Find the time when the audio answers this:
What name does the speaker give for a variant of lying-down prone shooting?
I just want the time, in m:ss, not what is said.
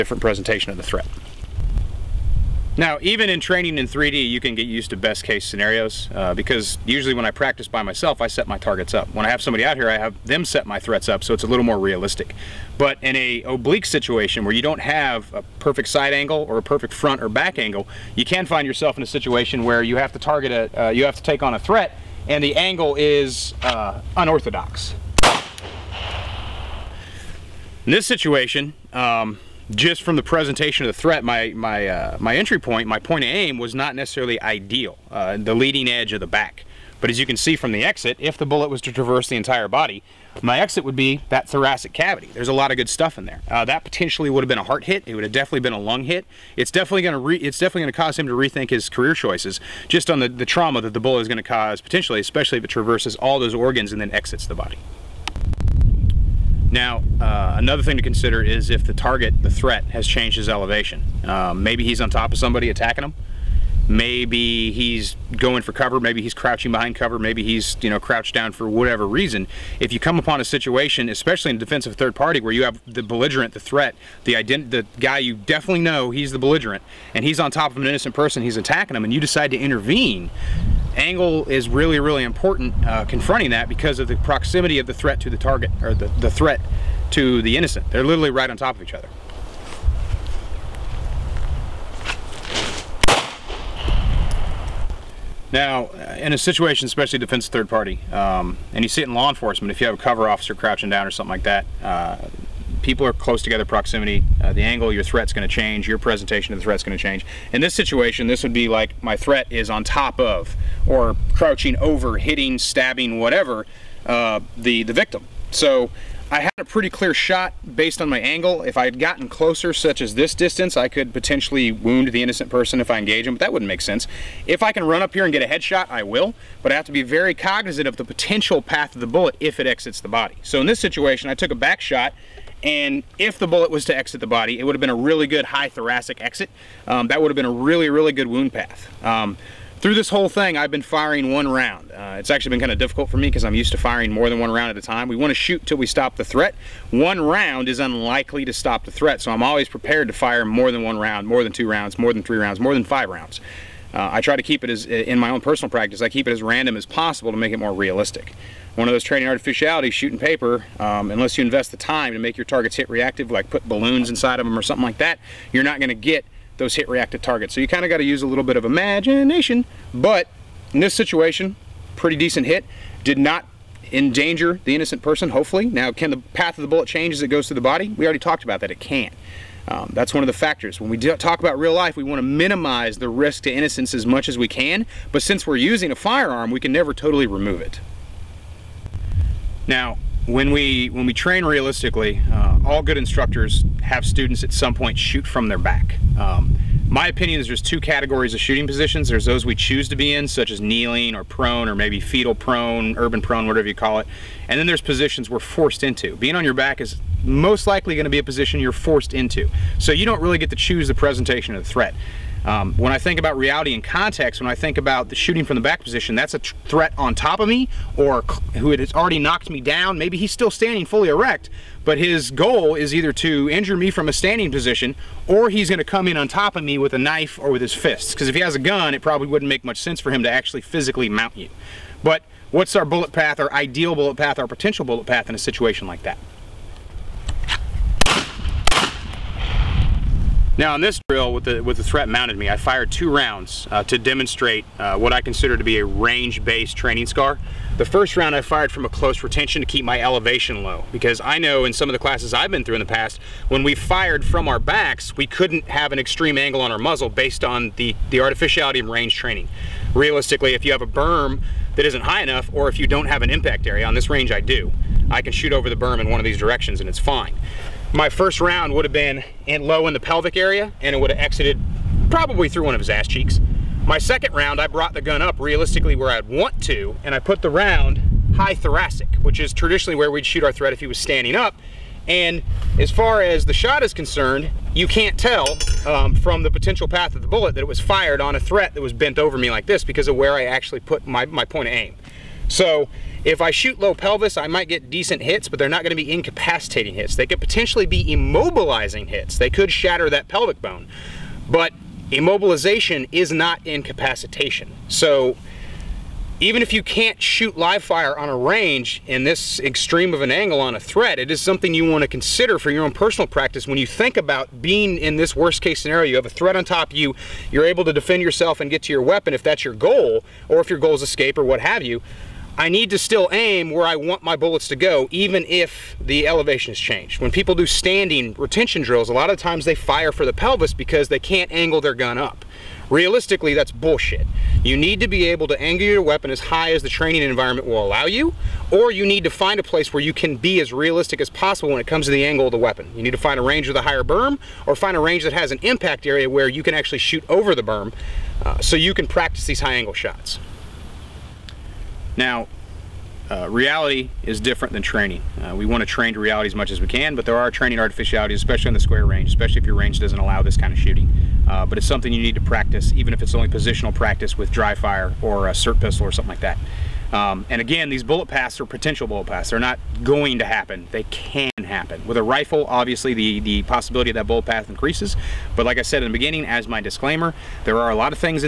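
3:21.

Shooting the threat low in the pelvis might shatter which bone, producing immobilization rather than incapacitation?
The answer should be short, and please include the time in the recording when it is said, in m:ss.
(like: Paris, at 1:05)
pelvic bone, at 5:00.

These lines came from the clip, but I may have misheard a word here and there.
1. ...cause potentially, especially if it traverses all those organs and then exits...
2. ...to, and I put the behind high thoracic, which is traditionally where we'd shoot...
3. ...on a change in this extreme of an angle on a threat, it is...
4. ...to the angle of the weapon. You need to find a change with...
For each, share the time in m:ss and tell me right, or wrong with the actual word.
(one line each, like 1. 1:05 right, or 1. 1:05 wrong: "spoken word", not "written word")
1. 0:51 right
2. 4:36 wrong: "round", not "behind"
3. 5:08 wrong: "range", not "change"
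4. 5:42 wrong: "range", not "change".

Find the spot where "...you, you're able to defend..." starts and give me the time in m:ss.
5:16.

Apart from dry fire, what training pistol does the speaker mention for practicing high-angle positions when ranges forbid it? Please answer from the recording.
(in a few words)
SIRT pistol.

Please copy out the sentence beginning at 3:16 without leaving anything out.
Um, my opinion is there's two categories of shooting positions.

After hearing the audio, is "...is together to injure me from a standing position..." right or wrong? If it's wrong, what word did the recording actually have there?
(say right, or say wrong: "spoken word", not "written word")
wrong: "either", not "together".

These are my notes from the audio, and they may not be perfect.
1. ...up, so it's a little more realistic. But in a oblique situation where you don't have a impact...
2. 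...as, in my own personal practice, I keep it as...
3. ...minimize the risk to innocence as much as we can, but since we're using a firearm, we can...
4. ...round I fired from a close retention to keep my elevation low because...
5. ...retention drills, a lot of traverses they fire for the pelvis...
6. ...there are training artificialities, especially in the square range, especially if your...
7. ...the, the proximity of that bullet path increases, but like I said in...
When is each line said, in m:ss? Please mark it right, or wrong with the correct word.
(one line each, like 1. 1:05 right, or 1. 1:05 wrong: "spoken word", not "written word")
1. 0:11 wrong: "perfect", not "impact"
2. 2:34 right
3. 3:02 right
4. 4:08 right
5. 5:28 wrong: "times", not "traverses"
6. 5:57 right
7. 6:13 wrong: "possibility", not "proximity".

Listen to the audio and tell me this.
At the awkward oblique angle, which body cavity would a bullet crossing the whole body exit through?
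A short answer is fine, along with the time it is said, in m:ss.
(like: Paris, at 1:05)
thoracic cavity, at 0:41.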